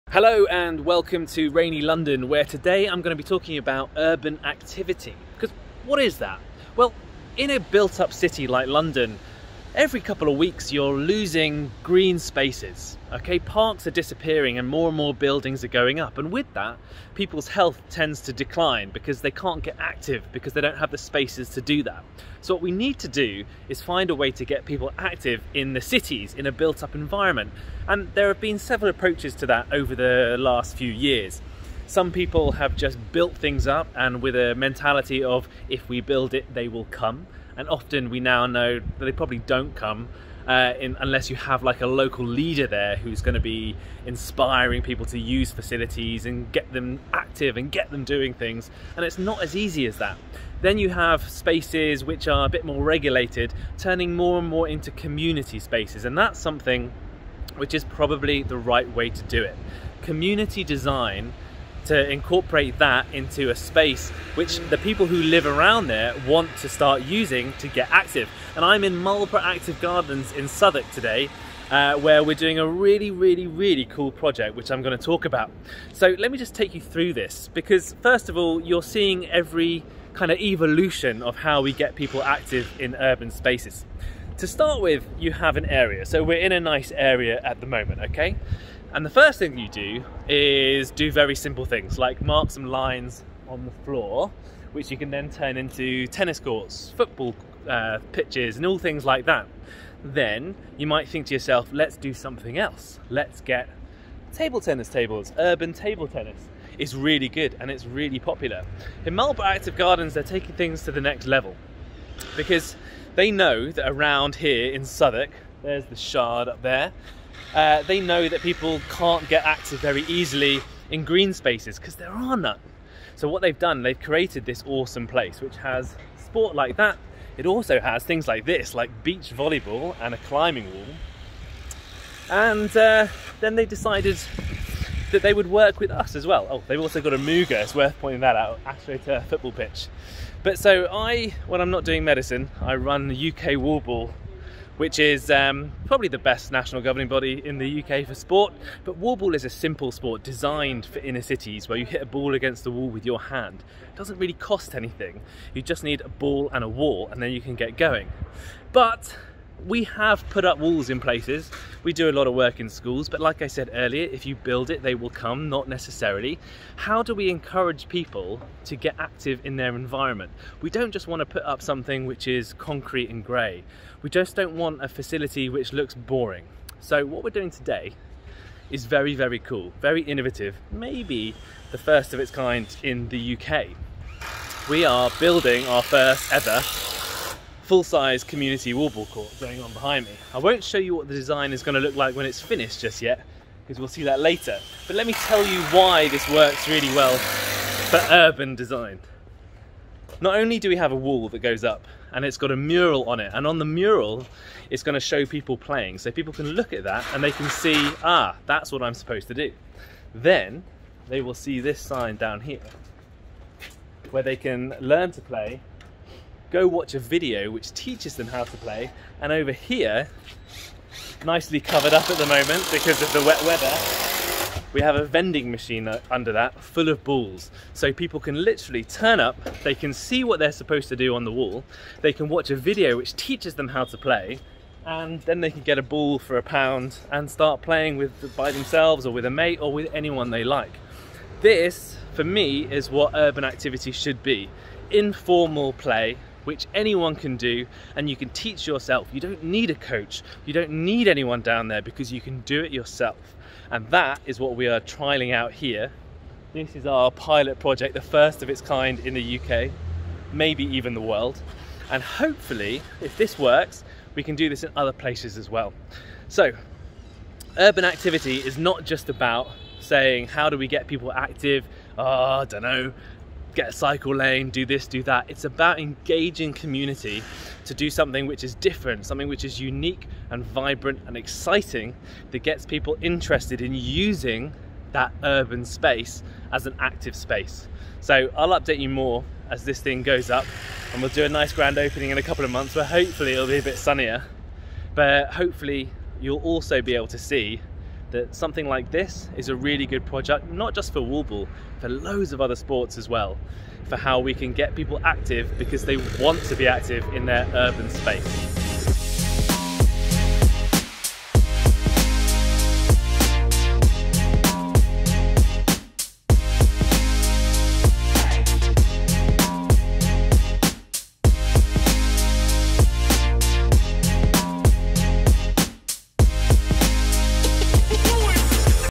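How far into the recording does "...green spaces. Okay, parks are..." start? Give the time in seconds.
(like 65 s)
11 s.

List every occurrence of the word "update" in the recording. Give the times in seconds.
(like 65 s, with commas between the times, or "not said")
288 s.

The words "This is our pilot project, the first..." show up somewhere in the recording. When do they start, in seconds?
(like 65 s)
256 s.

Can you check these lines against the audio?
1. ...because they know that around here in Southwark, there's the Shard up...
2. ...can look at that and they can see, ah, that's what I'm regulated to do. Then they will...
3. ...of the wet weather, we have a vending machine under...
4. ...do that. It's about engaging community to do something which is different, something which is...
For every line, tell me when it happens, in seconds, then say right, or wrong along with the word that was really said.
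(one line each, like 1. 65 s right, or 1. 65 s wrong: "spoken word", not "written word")
1. 112 s right
2. 206 s wrong: "supposed", not "regulated"
3. 223 s right
4. 274 s right.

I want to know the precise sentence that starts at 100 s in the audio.
Then you might think to yourself, let's do something else.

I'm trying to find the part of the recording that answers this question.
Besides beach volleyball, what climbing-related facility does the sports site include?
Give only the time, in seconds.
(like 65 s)
130 s.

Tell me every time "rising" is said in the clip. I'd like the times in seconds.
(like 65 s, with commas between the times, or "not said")
not said.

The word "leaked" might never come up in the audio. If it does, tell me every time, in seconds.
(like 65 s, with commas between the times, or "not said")
not said.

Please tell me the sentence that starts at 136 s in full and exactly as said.
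Oh, they've also got a Muga, it's worth pointing that out, AstroTurf football pitch.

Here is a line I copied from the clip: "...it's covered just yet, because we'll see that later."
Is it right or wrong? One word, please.
wrong.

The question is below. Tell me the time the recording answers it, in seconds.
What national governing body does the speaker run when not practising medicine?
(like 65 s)
143 s.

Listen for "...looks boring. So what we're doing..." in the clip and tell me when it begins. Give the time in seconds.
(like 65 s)
175 s.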